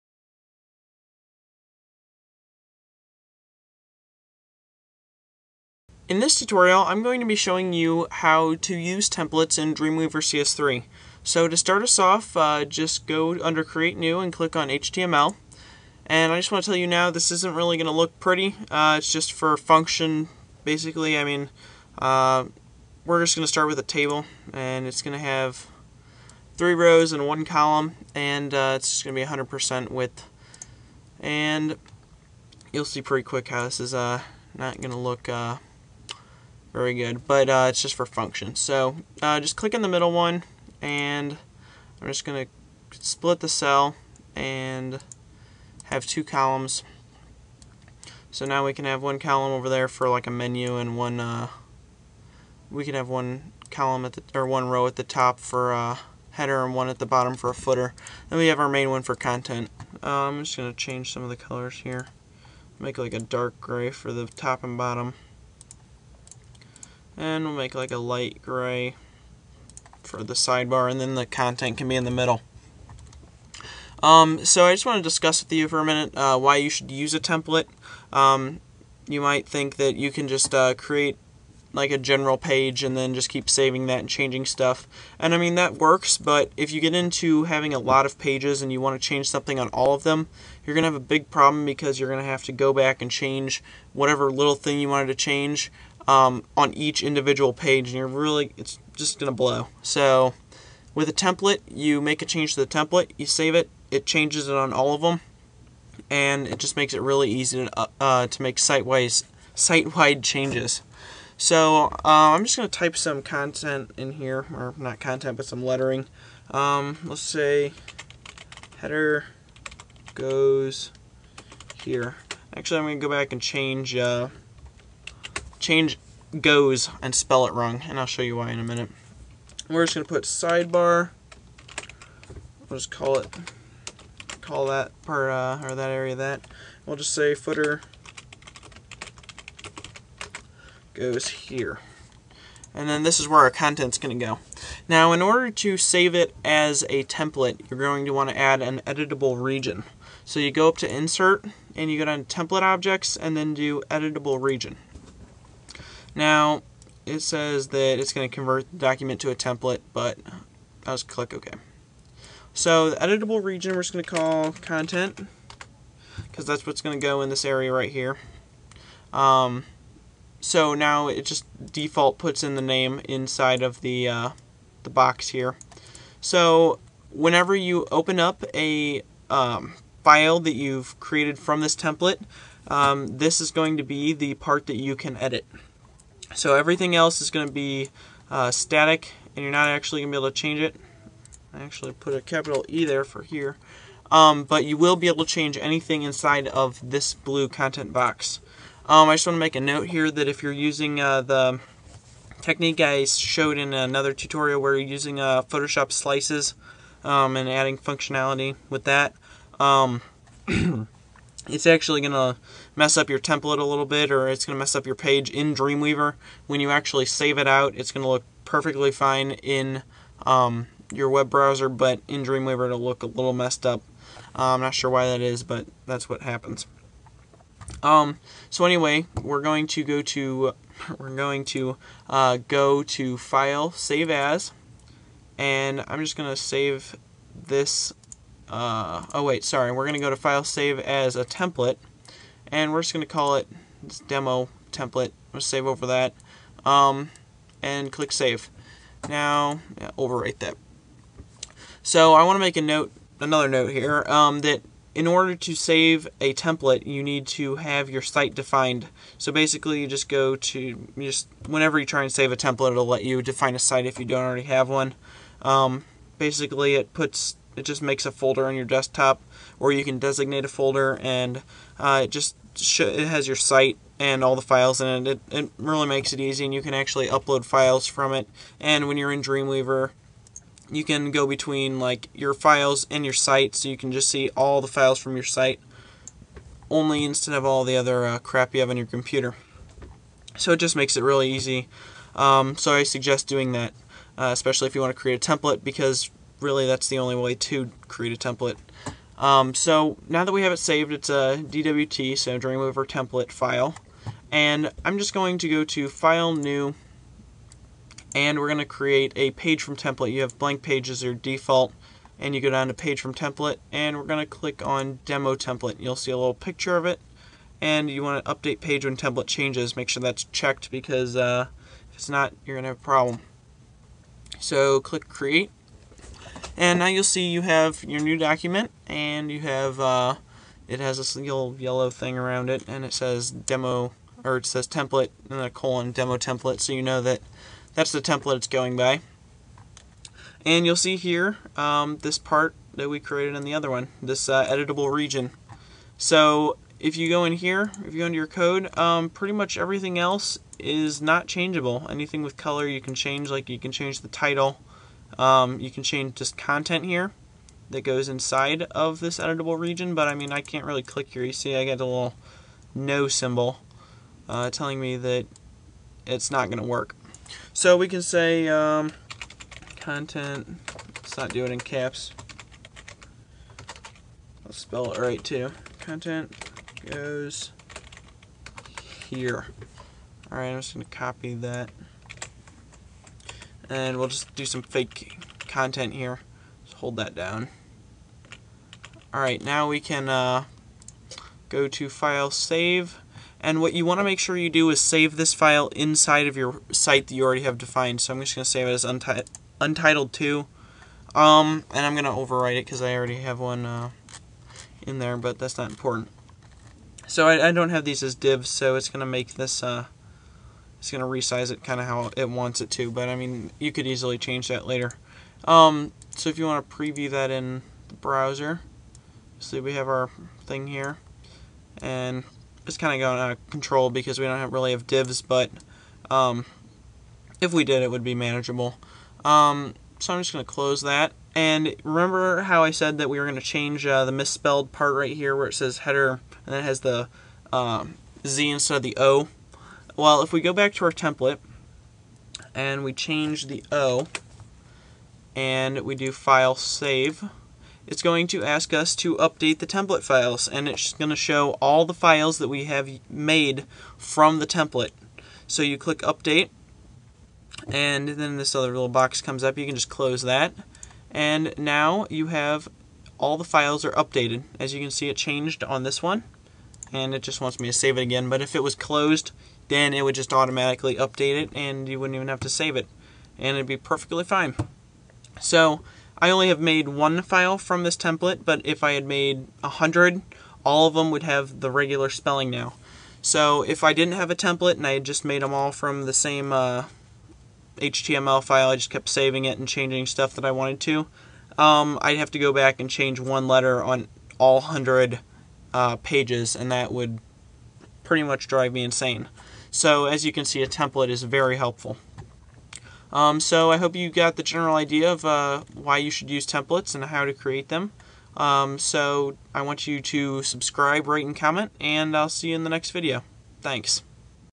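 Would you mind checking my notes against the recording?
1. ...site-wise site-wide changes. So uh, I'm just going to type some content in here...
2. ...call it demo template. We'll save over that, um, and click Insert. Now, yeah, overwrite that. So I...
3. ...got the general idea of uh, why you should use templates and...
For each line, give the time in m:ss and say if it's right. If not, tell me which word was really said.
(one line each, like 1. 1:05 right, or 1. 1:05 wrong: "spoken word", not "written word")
1. 1:48 right
2. 4:03 wrong: "Save", not "Insert"
3. 8:24 right.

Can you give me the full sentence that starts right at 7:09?
Um, so I'm just going to close that.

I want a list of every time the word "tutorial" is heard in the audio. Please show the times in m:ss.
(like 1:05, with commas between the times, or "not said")
0:06, 3:24.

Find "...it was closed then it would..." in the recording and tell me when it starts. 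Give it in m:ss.
7:48.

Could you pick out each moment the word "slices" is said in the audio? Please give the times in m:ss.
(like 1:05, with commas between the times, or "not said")
3:25.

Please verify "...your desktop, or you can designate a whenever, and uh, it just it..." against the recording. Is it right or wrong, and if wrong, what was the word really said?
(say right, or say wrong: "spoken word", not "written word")
wrong: "folder", not "whenever".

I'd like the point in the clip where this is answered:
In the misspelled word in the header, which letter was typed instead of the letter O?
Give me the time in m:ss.
7:18.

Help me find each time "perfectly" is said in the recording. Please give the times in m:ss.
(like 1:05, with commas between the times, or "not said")
3:38, 7:53.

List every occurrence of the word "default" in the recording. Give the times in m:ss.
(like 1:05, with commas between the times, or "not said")
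2:51, 5:11.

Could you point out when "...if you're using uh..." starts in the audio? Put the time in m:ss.
3:20.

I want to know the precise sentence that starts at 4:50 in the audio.
So it just makes it really easy.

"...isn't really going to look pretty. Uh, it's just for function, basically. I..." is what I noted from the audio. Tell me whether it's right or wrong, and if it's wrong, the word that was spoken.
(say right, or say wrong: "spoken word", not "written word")
right.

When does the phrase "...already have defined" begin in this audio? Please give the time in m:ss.
6:37.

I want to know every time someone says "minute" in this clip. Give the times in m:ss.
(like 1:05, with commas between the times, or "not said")
1:15, 2:08.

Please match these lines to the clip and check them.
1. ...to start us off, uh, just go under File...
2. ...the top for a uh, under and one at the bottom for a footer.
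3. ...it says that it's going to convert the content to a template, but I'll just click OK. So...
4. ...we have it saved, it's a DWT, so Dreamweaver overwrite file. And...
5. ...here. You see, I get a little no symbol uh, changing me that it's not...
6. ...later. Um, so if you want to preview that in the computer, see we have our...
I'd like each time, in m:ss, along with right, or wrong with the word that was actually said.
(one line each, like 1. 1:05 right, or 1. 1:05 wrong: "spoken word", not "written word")
1. 0:11 wrong: "Create", not "File"
2. 0:54 wrong: "header", not "under"
3. 2:37 wrong: "document", not "content"
4. 5:00 wrong: "template", not "overwrite"
5. 6:01 wrong: "telling", not "changing"
6. 6:54 wrong: "browser", not "computer".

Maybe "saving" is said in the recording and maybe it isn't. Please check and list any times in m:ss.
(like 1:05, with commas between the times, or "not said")
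1:23, 8:09.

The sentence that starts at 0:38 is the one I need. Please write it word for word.
So uh, just click in the middle one, and I'm just going to split the cell and have two columns.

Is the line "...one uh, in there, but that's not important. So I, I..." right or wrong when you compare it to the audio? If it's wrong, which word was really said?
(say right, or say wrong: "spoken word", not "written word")
right.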